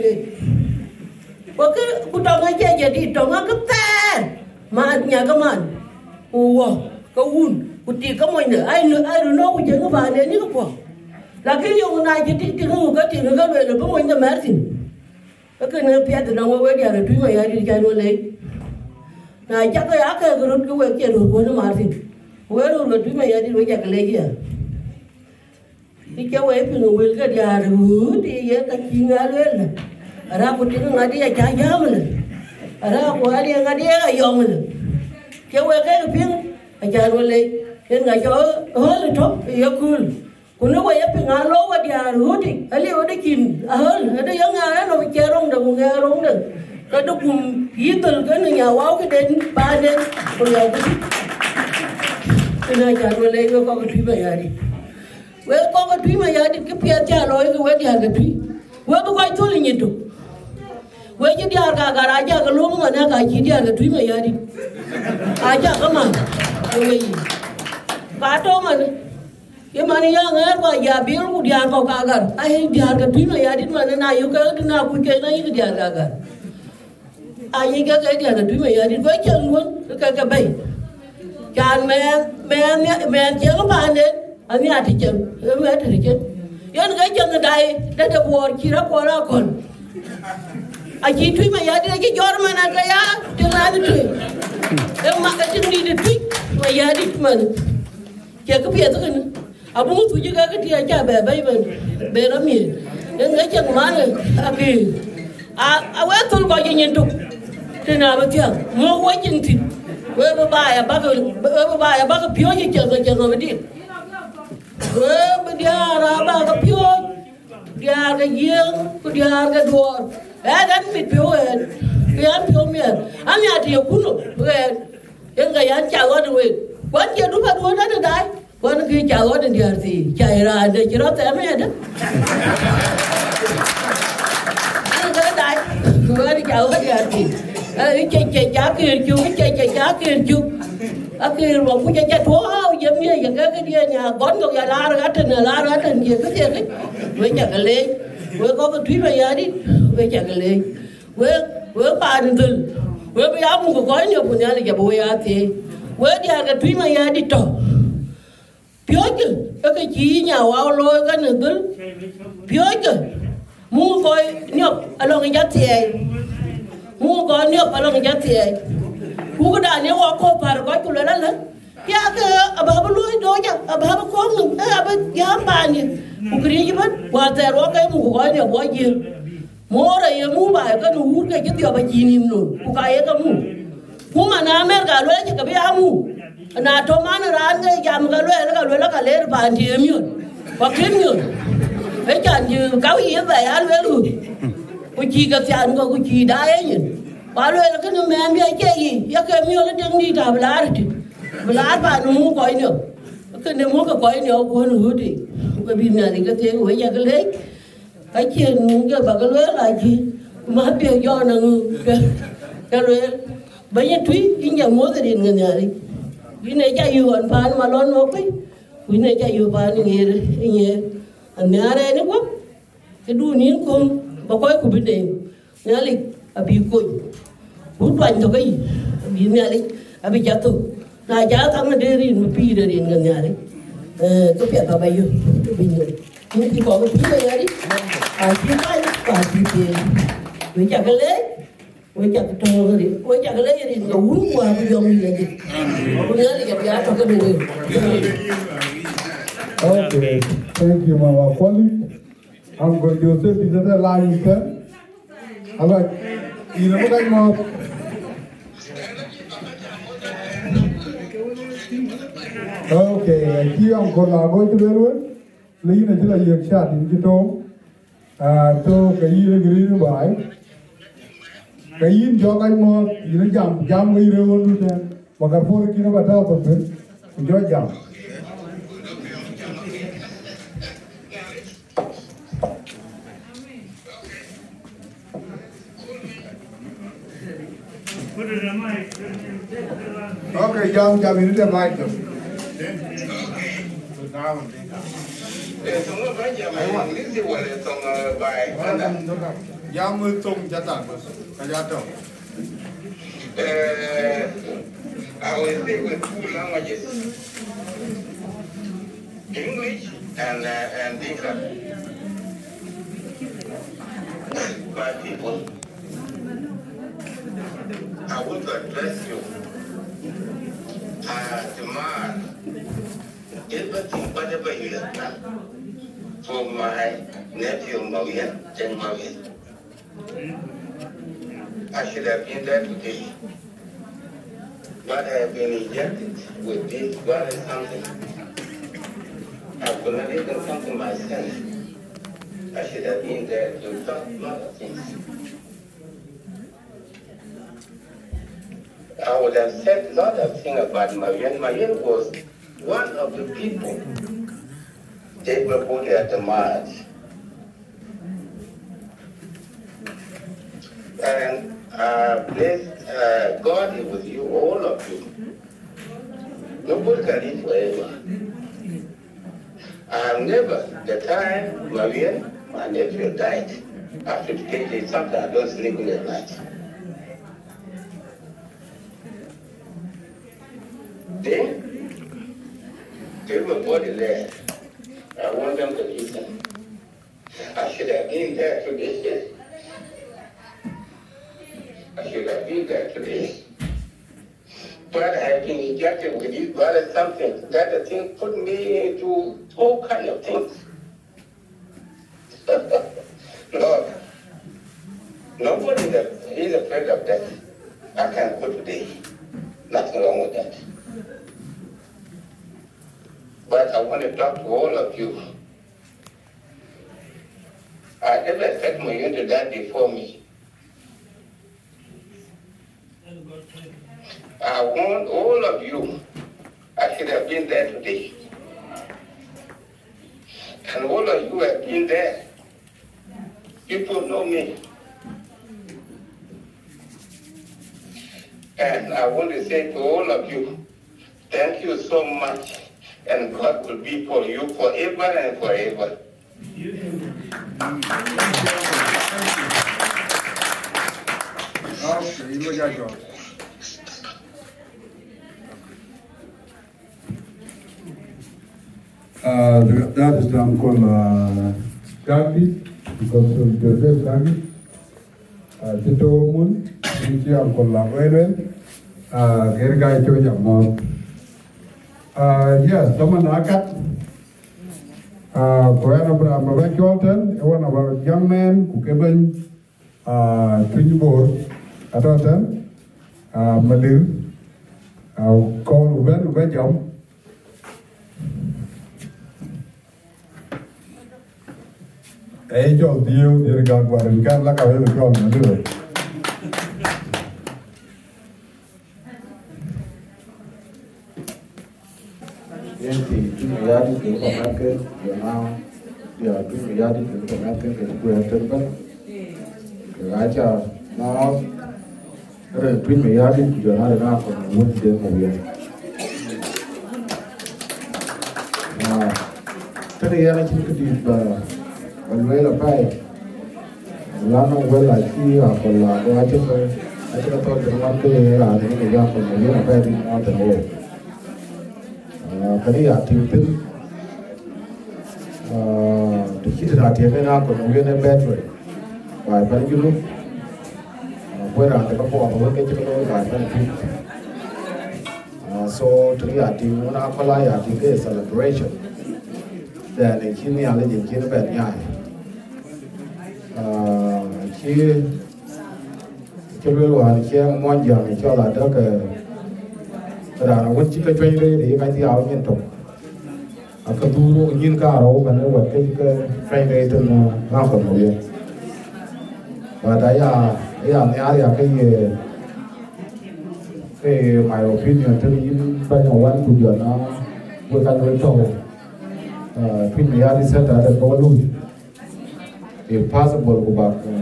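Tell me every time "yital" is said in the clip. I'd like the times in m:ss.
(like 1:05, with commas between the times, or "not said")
0:47.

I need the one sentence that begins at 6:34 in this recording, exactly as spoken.
But I've been injected with this virus something.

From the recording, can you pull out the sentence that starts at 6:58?
I never set my unit to that before me.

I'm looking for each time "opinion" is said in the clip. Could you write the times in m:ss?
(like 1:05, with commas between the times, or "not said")
9:34.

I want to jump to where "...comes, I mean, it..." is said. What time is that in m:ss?
4:50.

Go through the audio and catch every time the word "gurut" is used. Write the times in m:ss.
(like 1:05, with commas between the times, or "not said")
0:20.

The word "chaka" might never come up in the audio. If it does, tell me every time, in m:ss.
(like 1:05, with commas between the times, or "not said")
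0:19.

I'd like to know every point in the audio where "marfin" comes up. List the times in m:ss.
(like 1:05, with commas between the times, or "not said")
0:21.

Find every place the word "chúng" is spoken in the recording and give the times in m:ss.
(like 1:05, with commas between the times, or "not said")
0:17.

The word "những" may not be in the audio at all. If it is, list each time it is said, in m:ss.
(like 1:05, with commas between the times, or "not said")
4:26.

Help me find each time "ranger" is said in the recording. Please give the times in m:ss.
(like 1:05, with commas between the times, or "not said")
not said.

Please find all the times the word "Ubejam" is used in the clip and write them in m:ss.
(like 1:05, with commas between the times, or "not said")
8:06.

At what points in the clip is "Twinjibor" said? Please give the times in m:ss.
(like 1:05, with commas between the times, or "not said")
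8:00.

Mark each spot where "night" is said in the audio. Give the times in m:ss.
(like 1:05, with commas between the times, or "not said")
6:16.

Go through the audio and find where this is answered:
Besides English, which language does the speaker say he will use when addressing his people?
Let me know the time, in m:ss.
5:11.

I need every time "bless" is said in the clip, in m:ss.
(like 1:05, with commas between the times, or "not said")
6:02.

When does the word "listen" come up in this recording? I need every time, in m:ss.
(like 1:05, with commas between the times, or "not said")
6:25.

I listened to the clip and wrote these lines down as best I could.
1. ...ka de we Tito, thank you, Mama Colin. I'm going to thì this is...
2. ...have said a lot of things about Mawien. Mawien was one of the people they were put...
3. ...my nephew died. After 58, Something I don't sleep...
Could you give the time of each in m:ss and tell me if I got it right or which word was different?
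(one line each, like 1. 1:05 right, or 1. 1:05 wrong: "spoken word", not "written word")
1. 4:06 wrong: "Okay", not "Tito"
2. 5:49 right
3. 6:12 right.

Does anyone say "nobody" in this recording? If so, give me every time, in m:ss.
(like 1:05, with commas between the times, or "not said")
6:06, 6:45.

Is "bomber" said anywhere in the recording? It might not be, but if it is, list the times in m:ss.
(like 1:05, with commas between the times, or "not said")
not said.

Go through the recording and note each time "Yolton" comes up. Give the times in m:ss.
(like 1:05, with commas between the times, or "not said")
7:56.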